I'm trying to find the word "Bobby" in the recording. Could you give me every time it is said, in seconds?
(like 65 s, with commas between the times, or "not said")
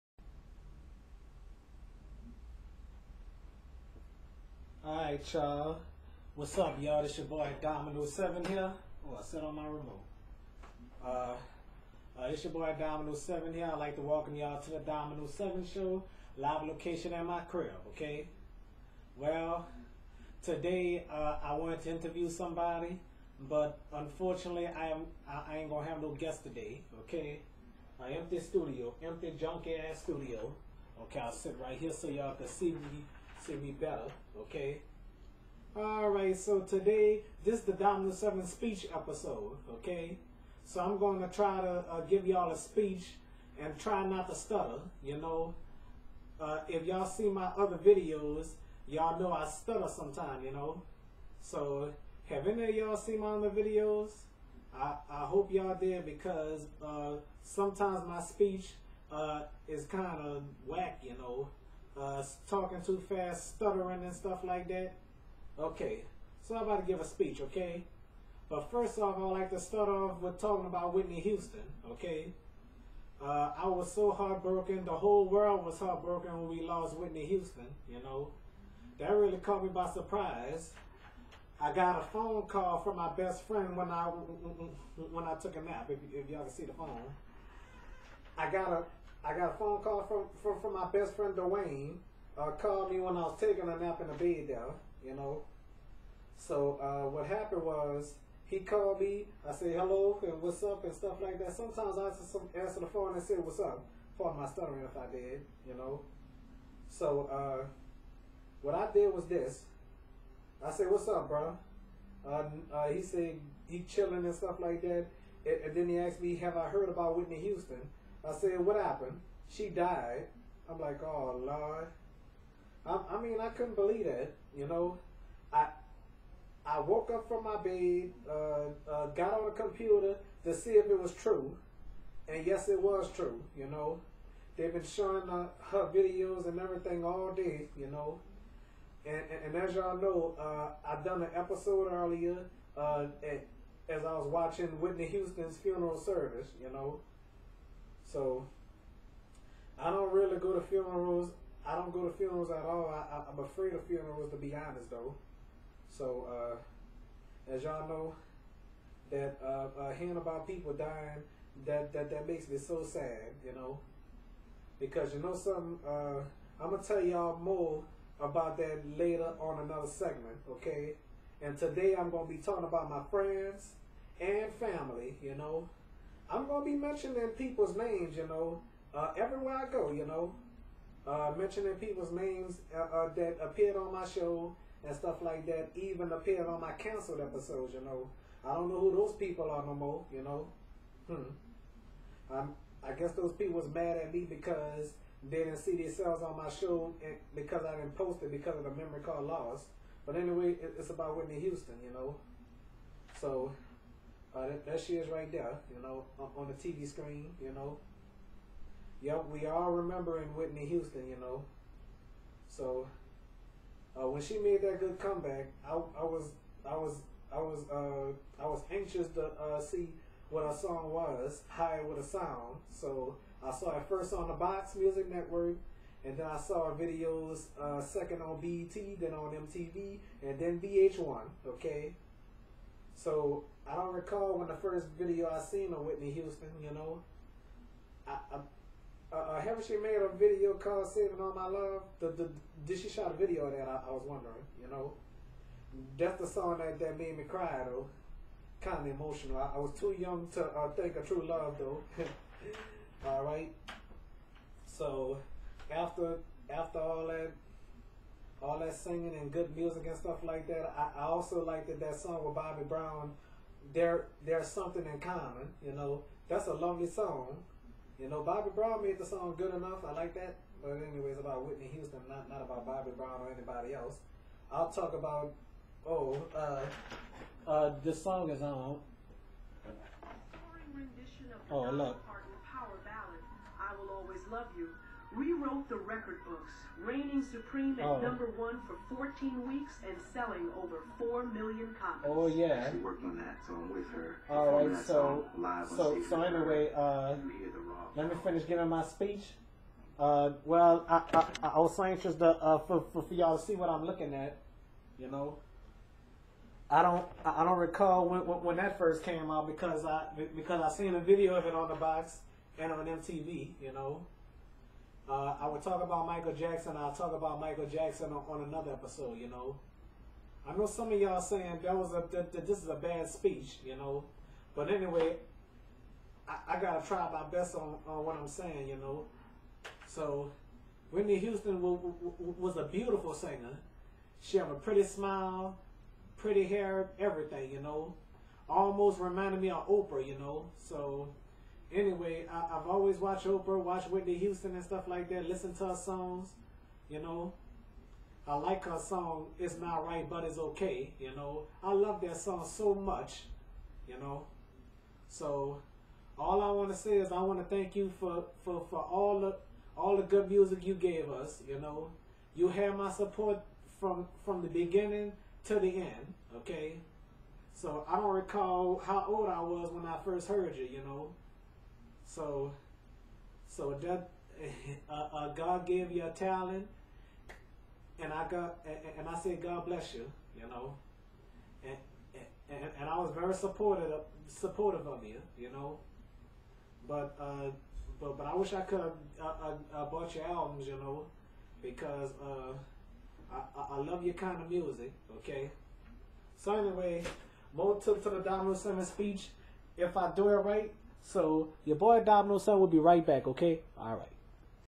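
262 s, 268 s, 272 s.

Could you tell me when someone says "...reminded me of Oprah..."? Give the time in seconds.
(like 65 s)
338 s.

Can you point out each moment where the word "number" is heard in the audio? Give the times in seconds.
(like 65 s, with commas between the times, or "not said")
288 s.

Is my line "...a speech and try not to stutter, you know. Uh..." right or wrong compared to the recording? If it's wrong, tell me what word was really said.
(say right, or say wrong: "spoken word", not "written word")
right.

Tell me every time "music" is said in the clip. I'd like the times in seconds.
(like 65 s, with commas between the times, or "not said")
224 s, 259 s, 360 s, 394 s.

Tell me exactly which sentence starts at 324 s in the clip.
But anyway, I, I, gotta try my best on, on what I'm saying, you know.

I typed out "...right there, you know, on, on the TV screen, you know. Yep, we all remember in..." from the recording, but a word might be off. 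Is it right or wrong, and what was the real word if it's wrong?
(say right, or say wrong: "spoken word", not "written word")
right.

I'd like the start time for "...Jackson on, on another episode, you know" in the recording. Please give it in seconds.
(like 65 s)
317 s.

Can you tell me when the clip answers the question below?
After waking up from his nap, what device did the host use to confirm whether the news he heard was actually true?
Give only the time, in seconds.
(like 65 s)
129 s.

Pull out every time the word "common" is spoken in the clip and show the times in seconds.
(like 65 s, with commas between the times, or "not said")
265 s.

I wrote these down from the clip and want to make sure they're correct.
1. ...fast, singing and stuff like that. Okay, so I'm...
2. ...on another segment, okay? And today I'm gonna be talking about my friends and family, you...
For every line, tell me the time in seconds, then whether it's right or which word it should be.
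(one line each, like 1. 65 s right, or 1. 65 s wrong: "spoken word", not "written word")
1. 63 s wrong: "stuttering", not "singing"
2. 169 s right.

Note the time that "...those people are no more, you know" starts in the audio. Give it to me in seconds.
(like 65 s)
188 s.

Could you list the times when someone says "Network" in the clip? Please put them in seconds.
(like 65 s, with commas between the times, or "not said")
225 s.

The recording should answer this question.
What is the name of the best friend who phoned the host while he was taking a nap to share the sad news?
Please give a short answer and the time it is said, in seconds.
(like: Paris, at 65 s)
Dwayne, at 91 s.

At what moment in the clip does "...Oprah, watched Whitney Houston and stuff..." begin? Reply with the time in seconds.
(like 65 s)
343 s.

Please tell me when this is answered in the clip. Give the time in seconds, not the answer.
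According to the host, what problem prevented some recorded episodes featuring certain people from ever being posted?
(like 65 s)
198 s.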